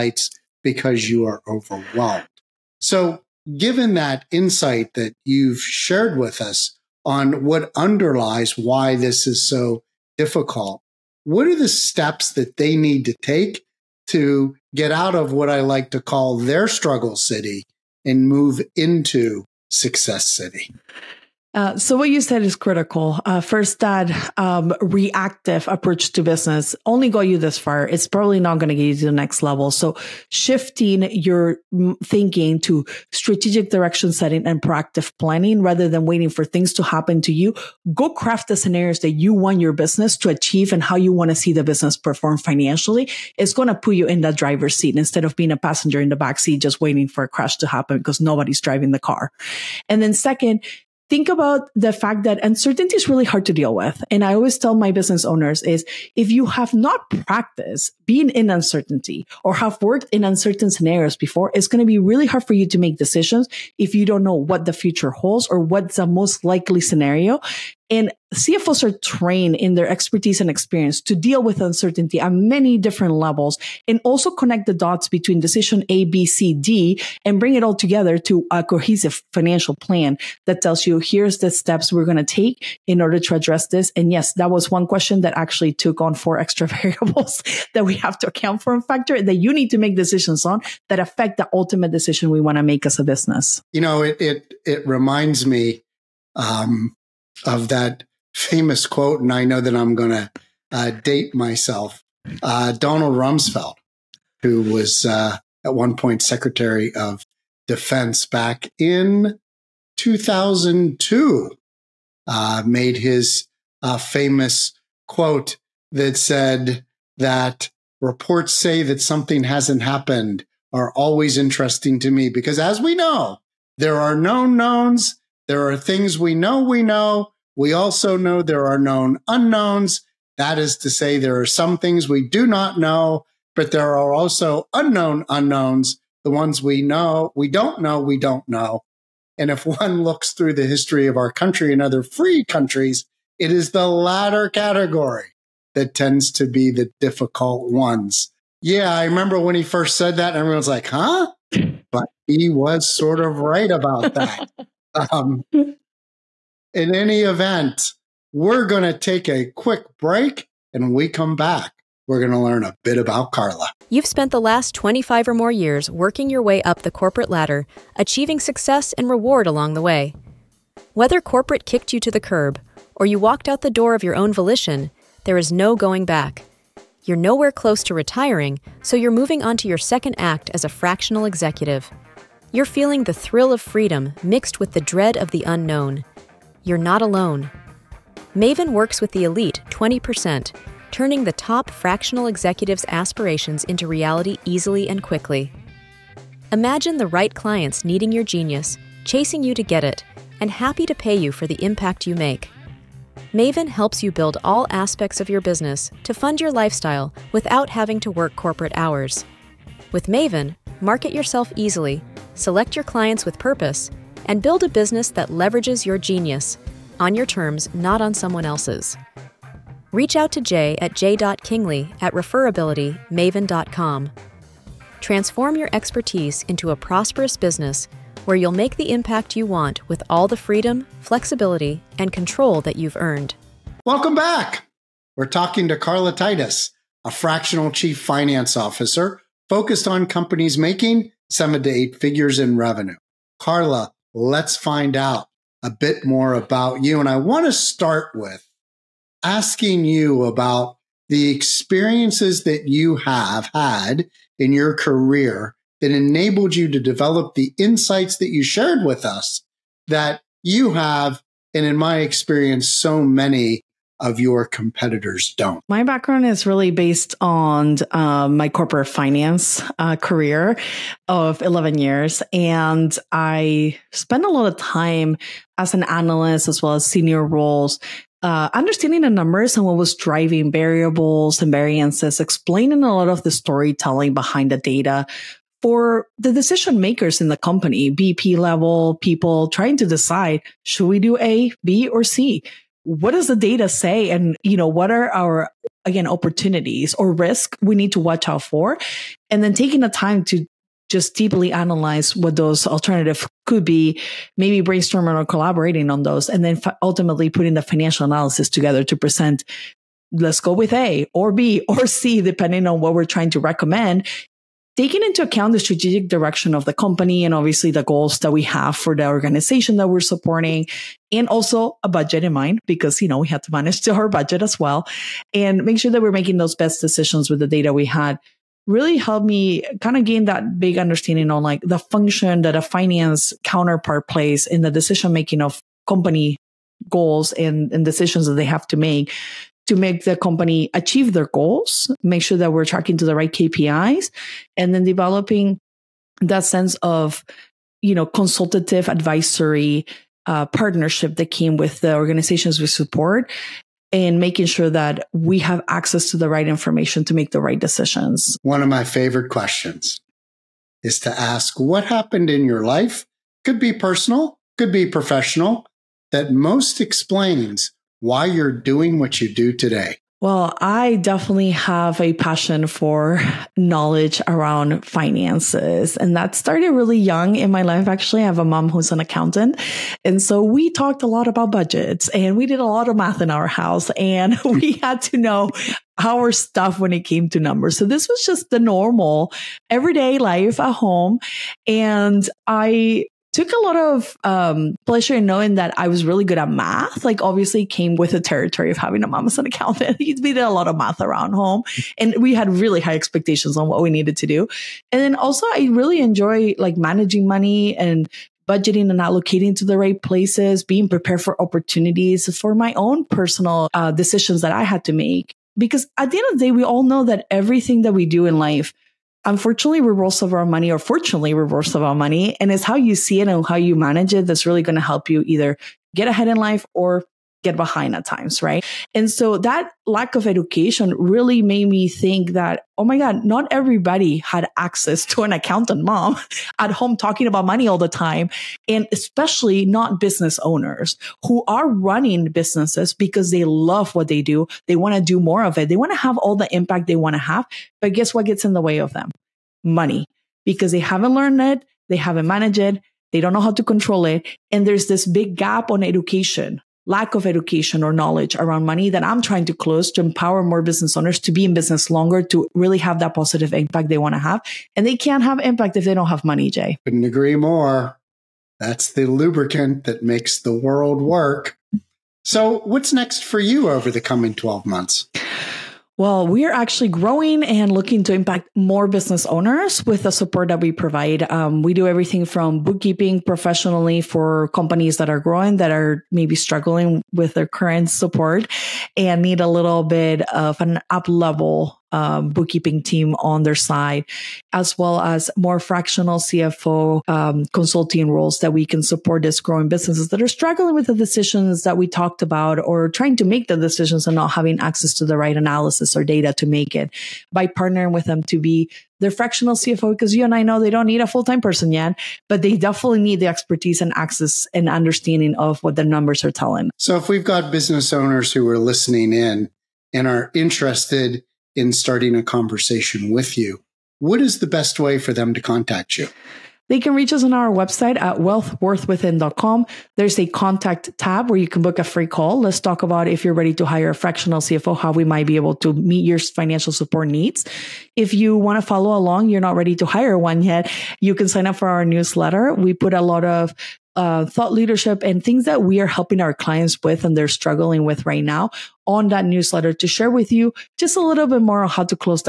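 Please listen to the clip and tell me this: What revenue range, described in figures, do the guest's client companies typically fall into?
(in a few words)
7 to 8 figures.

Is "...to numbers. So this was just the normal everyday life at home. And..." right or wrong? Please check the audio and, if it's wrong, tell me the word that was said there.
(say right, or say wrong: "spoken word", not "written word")
right.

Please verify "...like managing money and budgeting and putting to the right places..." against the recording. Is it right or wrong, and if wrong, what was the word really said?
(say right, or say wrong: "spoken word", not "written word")
wrong: "allocating", not "putting".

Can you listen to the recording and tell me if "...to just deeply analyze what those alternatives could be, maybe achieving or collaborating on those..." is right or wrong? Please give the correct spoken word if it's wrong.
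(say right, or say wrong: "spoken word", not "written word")
wrong: "brainstorming", not "achieving".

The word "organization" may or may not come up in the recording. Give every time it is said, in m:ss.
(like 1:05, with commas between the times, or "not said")
5:19, 5:51.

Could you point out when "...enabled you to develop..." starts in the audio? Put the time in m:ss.
4:15.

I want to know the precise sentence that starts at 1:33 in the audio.
You know, it, it, it reminds me, um, of that famous quote, and I know that I'm going to uh, date myself.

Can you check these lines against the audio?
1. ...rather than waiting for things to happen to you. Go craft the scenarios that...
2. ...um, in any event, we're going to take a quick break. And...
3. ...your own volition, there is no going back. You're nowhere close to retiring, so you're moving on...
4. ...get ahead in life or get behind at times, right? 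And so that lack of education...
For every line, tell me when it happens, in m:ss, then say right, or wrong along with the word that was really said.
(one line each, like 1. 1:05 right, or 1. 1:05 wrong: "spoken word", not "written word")
1. 0:35 right
2. 2:35 right
3. 2:54 right
4. 7:05 right.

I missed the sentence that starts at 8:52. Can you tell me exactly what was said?
Let's talk about if you're ready to hire a fractional CFO, how we might be able to meet your financial support needs.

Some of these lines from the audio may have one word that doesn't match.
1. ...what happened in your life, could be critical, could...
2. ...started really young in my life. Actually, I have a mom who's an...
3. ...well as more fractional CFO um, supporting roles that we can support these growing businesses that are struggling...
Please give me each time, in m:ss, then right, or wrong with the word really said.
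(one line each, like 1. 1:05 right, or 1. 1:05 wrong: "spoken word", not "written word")
1. 6:01 wrong: "personal", not "critical"
2. 6:16 right
3. 8:14 wrong: "consulting", not "supporting".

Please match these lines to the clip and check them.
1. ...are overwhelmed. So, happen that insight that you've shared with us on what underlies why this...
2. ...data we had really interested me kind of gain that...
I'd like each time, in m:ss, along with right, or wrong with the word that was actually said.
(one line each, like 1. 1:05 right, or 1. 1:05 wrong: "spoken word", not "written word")
1. 0:01 wrong: "given", not "happen"
2. 5:27 wrong: "helped", not "interested".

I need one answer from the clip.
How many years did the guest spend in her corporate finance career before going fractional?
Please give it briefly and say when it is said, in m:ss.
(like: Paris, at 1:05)
11, at 4:31.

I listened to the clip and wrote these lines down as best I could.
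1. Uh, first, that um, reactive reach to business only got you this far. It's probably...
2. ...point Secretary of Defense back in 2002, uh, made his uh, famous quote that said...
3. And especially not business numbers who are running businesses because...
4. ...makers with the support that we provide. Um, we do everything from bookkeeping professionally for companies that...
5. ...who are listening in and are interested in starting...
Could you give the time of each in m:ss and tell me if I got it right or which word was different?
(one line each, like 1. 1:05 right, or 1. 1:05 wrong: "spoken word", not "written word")
1. 0:23 wrong: "approach", not "reach"
2. 1:45 right
3. 7:18 wrong: "owners", not "numbers"
4. 7:59 wrong: "owners", not "makers"
5. 8:38 right.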